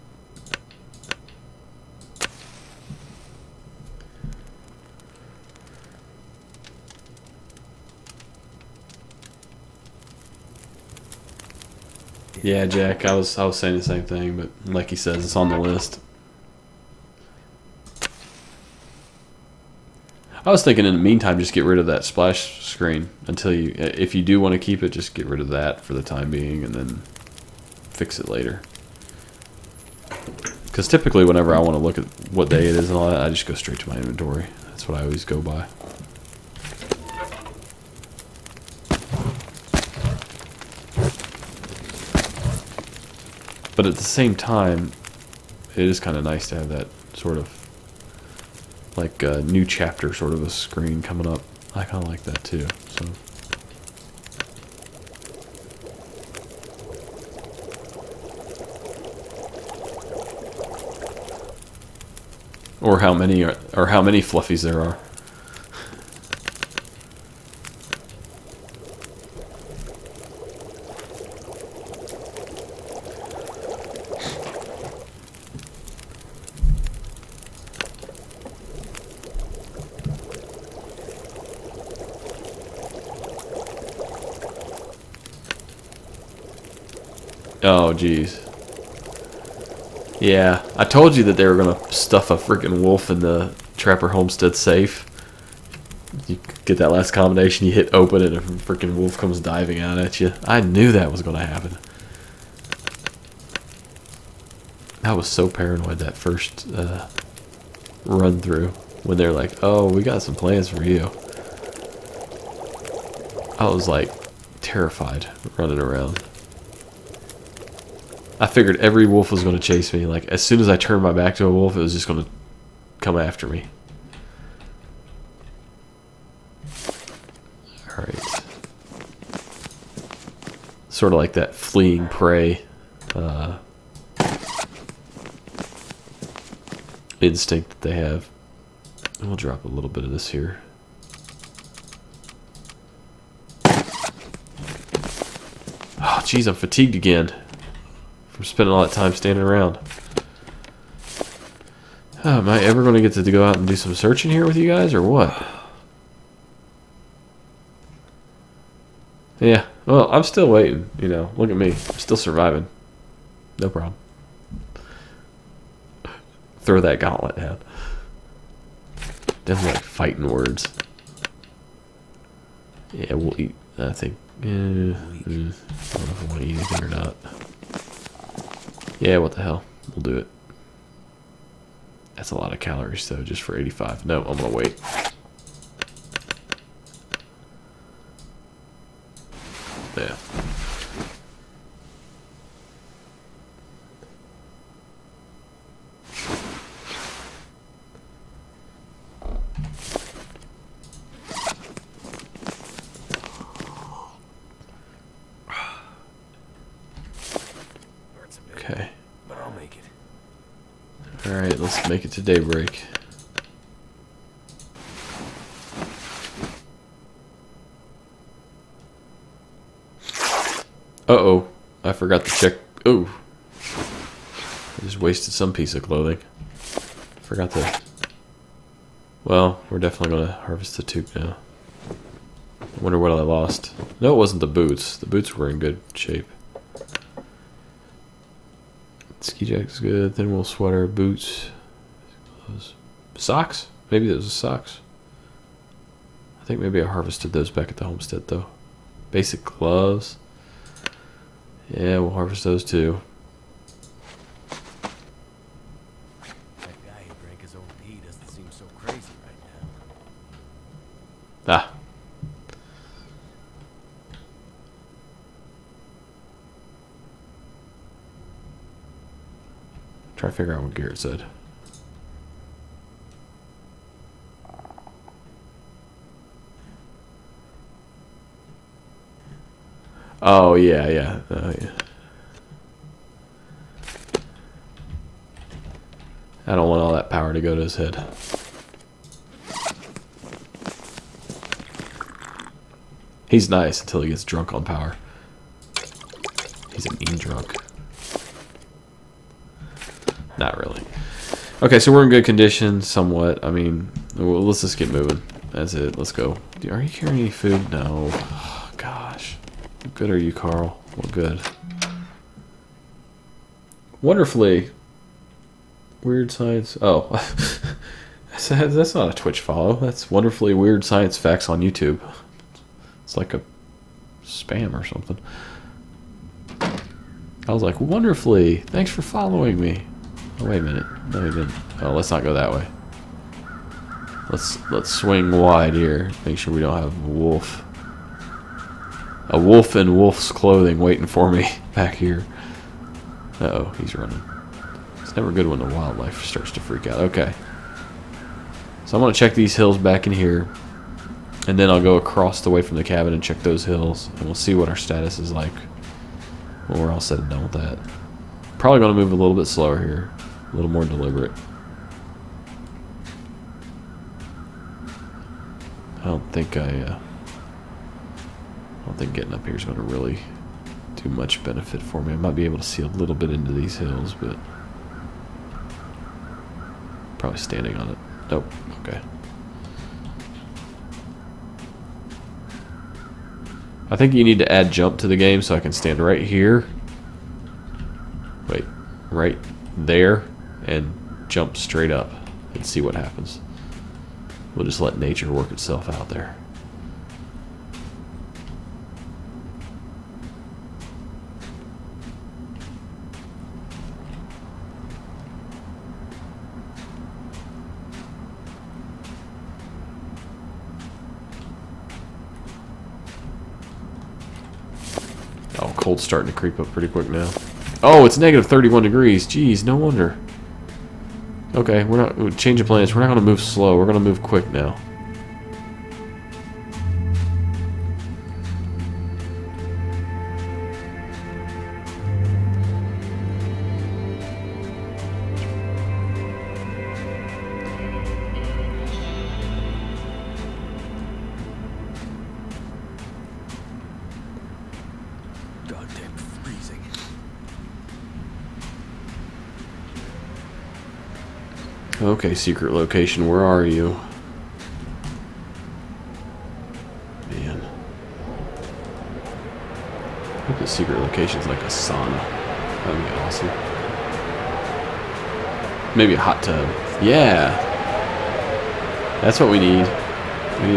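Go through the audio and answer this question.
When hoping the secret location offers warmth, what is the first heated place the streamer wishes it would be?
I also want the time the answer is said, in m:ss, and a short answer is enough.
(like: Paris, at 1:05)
a sauna, at 7:41.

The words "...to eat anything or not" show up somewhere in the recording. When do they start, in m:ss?
2:56.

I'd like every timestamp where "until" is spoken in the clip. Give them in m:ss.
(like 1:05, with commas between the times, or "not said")
0:23, 4:53.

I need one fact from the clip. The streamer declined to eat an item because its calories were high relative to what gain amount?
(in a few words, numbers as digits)
85.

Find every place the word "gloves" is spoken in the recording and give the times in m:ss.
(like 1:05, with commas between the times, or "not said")
4:09.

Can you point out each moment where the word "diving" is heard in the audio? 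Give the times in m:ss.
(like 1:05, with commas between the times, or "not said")
1:39.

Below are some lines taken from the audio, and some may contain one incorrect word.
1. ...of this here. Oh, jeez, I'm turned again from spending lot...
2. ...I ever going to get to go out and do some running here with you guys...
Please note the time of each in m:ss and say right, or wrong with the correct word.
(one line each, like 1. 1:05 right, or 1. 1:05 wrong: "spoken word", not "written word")
1. 2:20 wrong: "fatigued", not "turned"
2. 2:32 wrong: "searching", not "running".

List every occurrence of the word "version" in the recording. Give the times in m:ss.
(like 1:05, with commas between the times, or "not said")
not said.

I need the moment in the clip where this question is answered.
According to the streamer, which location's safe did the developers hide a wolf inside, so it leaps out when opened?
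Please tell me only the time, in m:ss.
1:33.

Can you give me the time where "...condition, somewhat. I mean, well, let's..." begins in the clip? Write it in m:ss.
5:02.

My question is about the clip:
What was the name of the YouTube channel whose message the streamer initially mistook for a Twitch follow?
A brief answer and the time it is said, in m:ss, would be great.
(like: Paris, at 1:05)
Wonderfully Weird Science Facts, at 5:20.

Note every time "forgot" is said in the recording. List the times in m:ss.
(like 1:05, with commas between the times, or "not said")
3:41, 3:47.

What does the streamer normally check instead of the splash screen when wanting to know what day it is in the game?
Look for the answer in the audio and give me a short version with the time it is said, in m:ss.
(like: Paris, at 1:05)
inventory, at 0:33.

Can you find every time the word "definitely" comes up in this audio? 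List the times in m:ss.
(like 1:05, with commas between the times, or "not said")
2:49, 3:49.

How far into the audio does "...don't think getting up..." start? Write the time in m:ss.
6:08.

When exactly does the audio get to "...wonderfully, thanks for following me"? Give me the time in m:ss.
5:27.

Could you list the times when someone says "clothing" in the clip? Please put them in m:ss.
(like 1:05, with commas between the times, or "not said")
3:45, 5:40.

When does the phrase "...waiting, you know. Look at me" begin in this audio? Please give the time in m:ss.
2:40.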